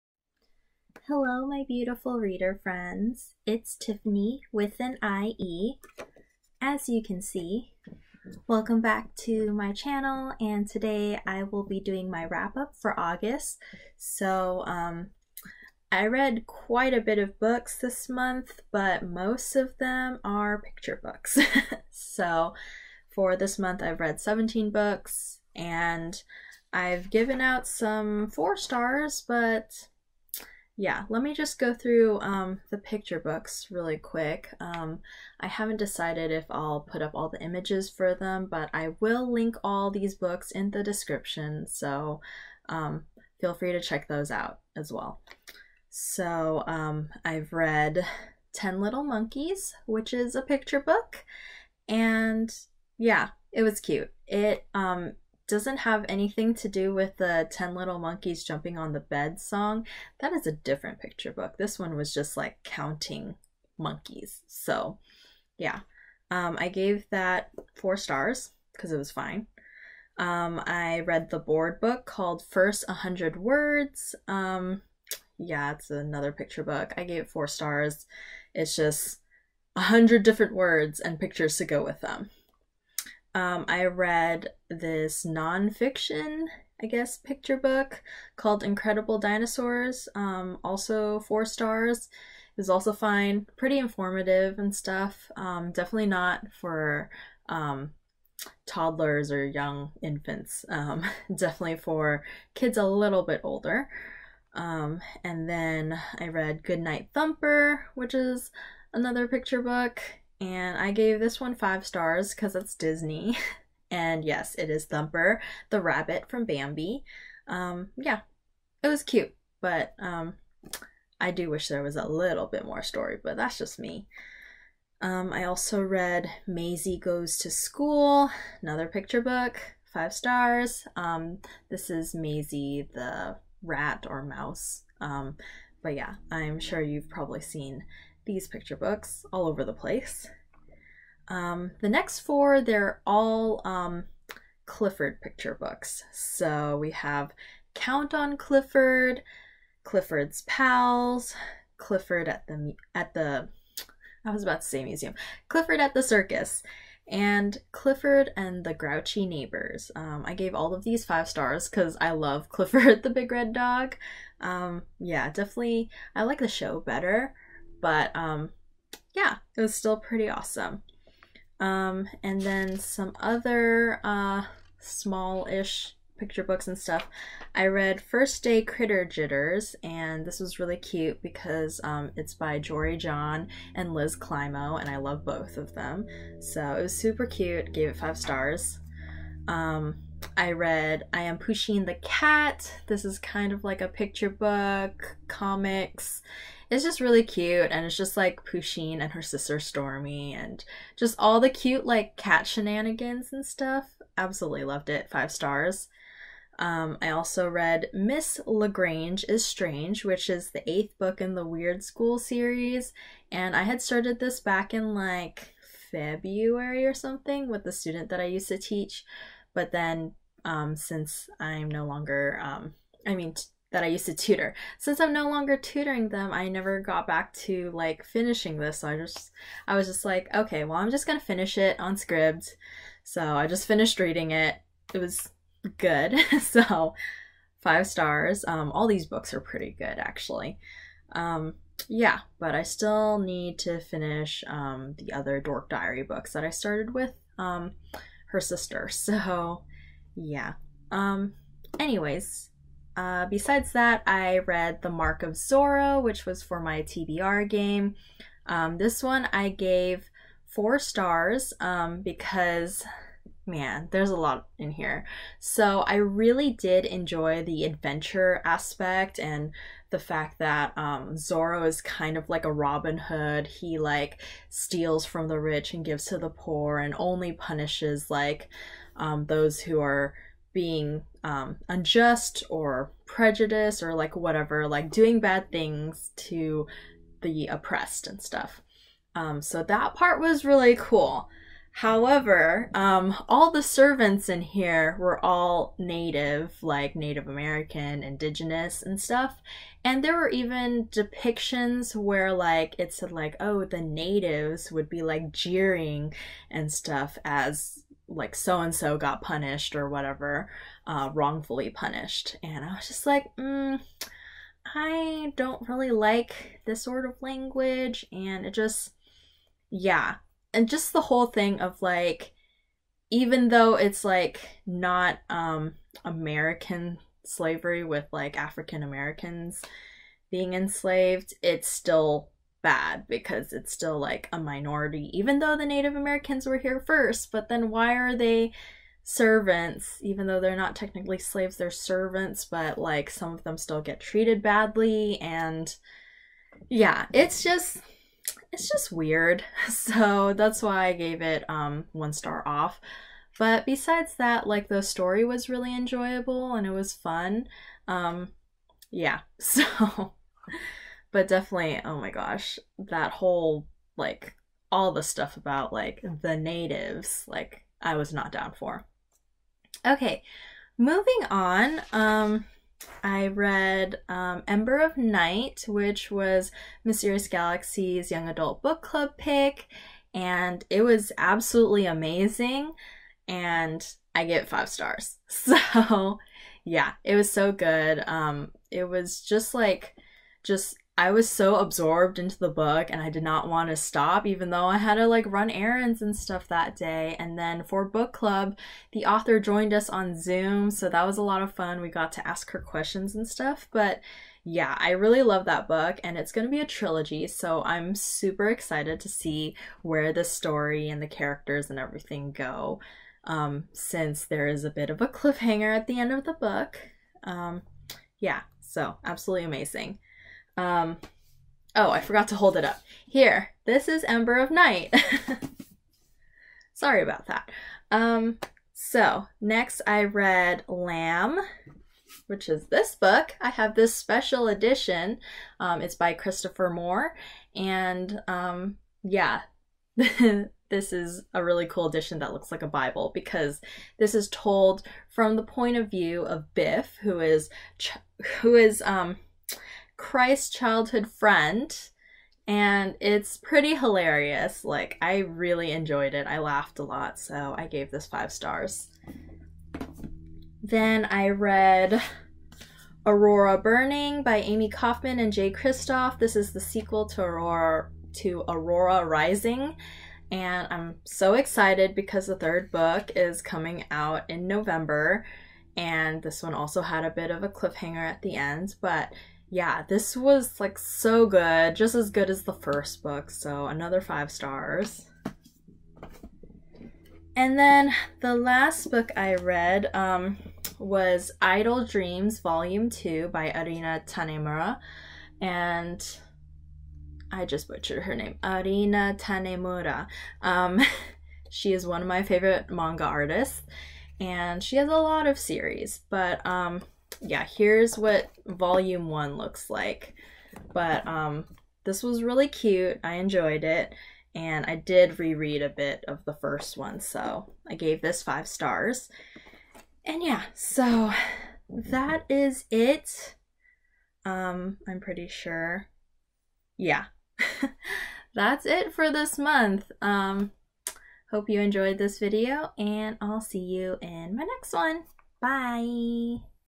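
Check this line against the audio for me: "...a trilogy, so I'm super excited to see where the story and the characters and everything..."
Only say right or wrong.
right.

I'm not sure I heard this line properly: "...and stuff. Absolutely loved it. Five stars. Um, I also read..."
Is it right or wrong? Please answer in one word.
right.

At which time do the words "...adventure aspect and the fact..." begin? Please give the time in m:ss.
4:27.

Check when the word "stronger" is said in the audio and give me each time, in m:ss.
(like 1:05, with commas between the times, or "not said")
not said.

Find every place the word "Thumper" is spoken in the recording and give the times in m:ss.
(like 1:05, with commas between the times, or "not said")
1:47, 1:54.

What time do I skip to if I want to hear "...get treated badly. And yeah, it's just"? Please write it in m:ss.
5:43.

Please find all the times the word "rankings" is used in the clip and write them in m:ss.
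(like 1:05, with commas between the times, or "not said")
not said.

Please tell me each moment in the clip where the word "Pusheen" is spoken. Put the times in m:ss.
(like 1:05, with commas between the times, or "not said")
3:11, 3:18.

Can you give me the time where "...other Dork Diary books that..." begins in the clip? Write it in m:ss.
4:05.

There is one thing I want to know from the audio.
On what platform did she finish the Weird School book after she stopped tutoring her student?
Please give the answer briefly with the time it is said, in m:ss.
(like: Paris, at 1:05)
Scribd, at 3:51.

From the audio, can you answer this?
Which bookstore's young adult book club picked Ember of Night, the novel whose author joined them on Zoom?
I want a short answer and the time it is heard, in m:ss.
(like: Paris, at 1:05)
Mysterious Galaxy, at 6:16.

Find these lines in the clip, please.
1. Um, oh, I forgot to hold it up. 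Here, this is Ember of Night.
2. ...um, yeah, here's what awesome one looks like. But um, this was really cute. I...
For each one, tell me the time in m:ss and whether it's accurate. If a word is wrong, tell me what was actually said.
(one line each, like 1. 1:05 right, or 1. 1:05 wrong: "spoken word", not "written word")
1. 7:00 right
2. 8:26 wrong: "volume", not "awesome".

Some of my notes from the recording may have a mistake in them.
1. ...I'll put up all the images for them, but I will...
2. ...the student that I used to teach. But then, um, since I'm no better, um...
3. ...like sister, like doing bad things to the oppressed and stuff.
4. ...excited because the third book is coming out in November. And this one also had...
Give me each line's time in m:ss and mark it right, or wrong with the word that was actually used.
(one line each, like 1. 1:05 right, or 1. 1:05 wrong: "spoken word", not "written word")
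1. 0:36 right
2. 3:37 wrong: "longer", not "better"
3. 4:43 wrong: "whatever", not "sister"
4. 7:51 right.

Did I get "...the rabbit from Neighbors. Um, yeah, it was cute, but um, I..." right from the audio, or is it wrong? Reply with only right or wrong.
wrong.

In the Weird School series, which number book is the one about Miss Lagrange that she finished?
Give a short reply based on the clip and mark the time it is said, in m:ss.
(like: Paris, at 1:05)
eighth, at 3:30.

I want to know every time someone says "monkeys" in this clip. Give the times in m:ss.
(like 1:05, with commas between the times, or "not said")
0:49, 0:57, 1:03.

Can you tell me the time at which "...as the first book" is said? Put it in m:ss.
8:02.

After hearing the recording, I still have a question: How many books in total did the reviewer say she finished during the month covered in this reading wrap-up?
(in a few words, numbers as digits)
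17.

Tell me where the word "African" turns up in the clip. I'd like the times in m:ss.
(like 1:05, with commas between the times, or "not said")
5:28.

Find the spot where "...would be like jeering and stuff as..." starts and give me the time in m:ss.
5:04.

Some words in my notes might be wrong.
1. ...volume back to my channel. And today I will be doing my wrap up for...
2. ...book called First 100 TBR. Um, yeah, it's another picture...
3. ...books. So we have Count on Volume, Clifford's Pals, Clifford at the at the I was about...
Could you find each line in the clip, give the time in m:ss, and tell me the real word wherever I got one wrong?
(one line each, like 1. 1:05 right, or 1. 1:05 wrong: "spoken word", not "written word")
1. 0:08 wrong: "welcome", not "volume"
2. 1:11 wrong: "Words", not "TBR"
3. 2:25 wrong: "Clifford", not "Volume".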